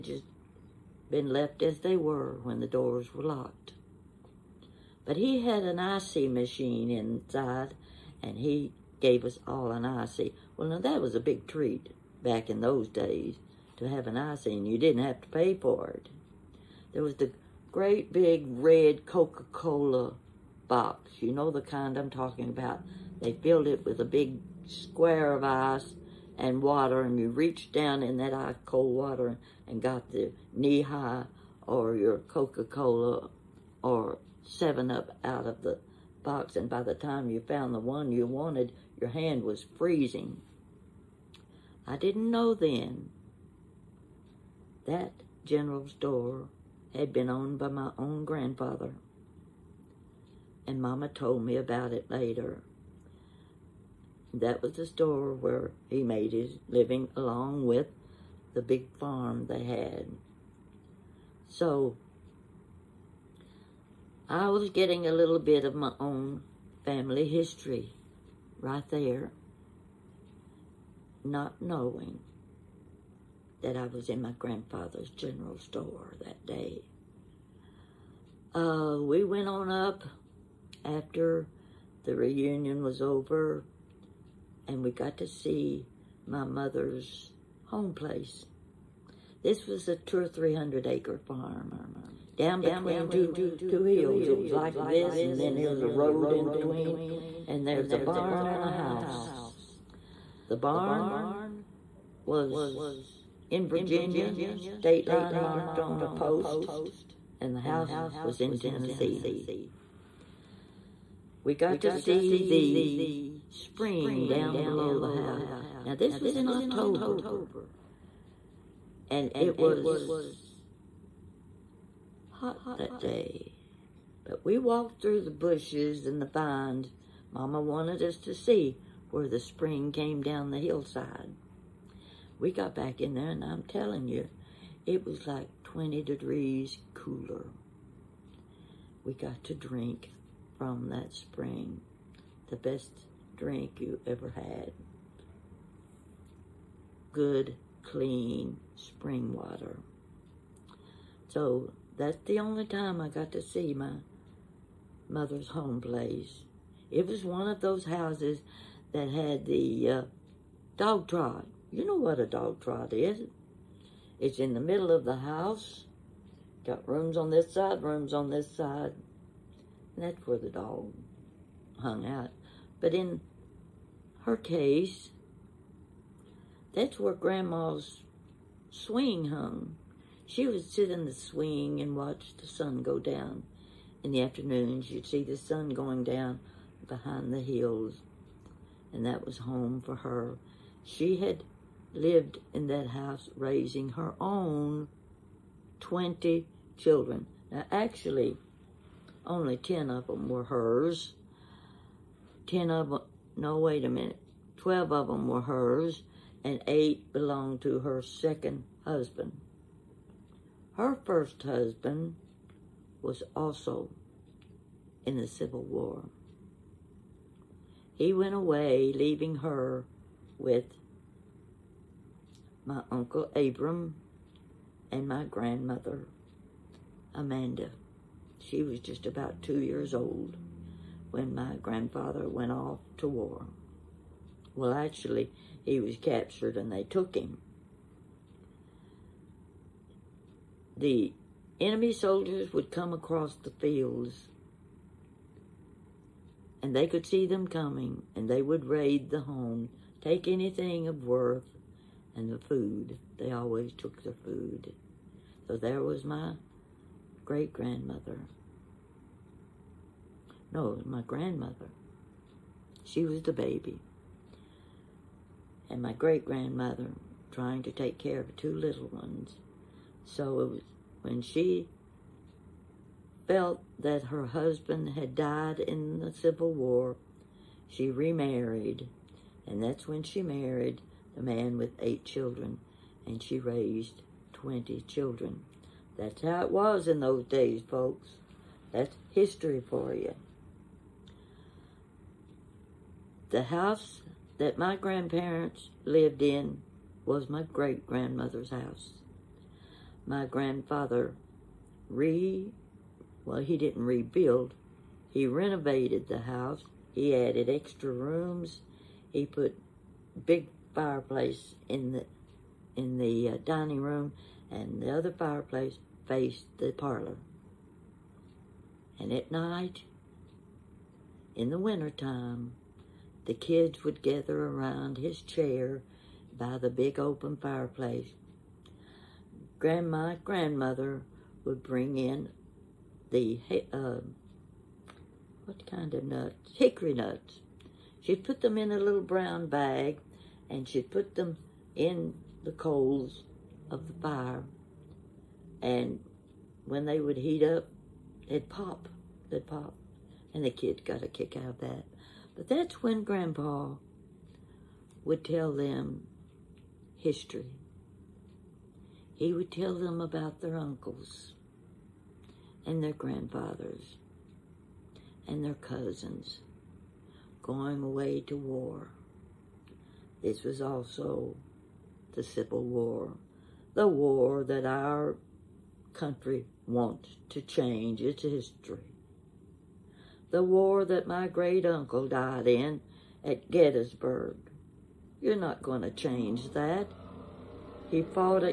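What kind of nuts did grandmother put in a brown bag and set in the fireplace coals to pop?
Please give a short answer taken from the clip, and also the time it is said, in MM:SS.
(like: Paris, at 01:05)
Hickory nuts, at 05:36.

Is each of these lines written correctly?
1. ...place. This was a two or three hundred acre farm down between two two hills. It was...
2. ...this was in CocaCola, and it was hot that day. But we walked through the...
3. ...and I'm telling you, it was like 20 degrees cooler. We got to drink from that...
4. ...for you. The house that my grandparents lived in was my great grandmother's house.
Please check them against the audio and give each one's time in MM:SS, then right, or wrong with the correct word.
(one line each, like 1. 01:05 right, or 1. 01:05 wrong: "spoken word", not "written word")
1. 01:27 right
2. 01:55 wrong: "October", not "CocaCola"
3. 02:13 right
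4. 04:49 right.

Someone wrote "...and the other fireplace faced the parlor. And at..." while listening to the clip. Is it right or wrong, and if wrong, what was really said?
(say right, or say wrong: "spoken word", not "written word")
right.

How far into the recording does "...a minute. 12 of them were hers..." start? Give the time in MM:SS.
03:23.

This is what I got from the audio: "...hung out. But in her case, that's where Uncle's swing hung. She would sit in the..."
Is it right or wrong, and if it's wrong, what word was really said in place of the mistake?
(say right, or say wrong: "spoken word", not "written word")
wrong: "Grandma", not "Uncle".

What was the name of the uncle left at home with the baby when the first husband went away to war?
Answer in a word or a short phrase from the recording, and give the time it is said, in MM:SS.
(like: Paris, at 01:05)
Abram, at 03:43.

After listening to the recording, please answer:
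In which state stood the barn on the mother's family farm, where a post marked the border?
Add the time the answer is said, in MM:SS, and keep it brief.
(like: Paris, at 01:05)
Virginia, at 01:43.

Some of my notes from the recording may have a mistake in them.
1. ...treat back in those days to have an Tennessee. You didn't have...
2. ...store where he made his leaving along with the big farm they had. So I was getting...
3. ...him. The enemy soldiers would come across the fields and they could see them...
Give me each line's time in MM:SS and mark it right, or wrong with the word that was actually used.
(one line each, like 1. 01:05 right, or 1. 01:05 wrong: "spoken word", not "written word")
1. 00:11 wrong: "ICEE", not "Tennessee"
2. 00:54 wrong: "living", not "leaving"
3. 03:57 right.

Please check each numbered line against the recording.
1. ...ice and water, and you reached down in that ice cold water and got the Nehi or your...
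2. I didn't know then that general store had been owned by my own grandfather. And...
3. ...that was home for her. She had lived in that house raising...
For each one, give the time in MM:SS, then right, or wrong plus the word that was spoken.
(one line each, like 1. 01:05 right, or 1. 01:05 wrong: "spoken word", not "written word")
1. 00:25 right
2. 00:41 right
3. 03:09 right.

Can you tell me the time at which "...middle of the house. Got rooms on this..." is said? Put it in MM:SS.
02:44.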